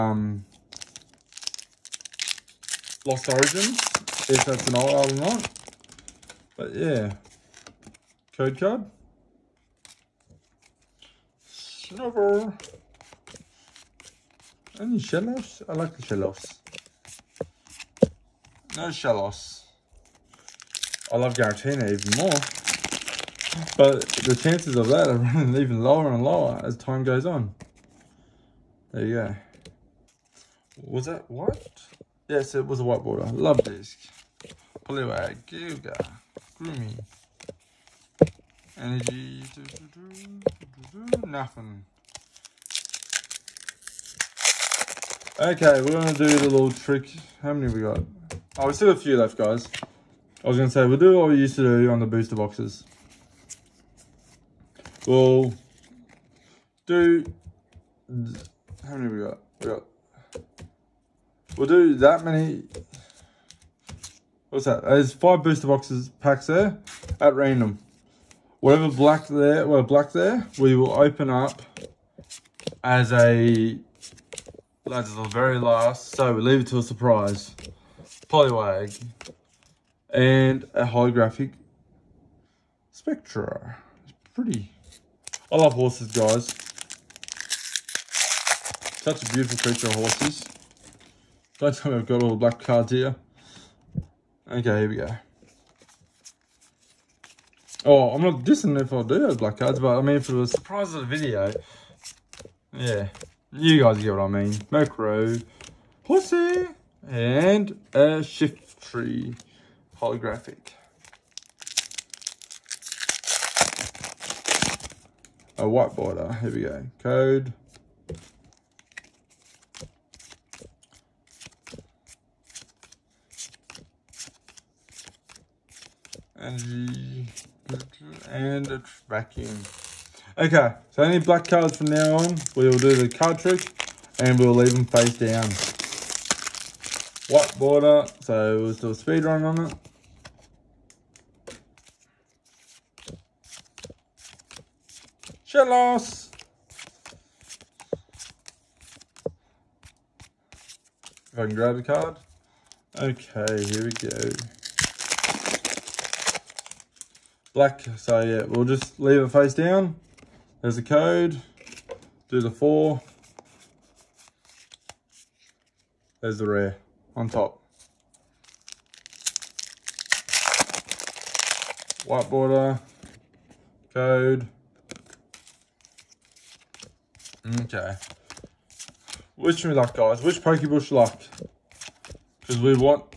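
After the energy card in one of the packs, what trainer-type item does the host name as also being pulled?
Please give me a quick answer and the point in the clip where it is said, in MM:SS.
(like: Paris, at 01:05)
Vacuum, at 02:09.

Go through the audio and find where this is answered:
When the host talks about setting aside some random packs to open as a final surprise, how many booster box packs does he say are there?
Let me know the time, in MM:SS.
01:05.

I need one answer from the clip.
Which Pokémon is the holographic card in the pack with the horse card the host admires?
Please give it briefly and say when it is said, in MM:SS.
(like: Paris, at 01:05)
Shiftry, at 01:48.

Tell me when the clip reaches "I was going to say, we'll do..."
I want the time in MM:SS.
00:50.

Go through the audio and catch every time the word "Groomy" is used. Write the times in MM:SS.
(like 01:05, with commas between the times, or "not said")
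00:36.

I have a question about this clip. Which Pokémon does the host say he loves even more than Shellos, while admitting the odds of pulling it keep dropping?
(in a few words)
Giratina.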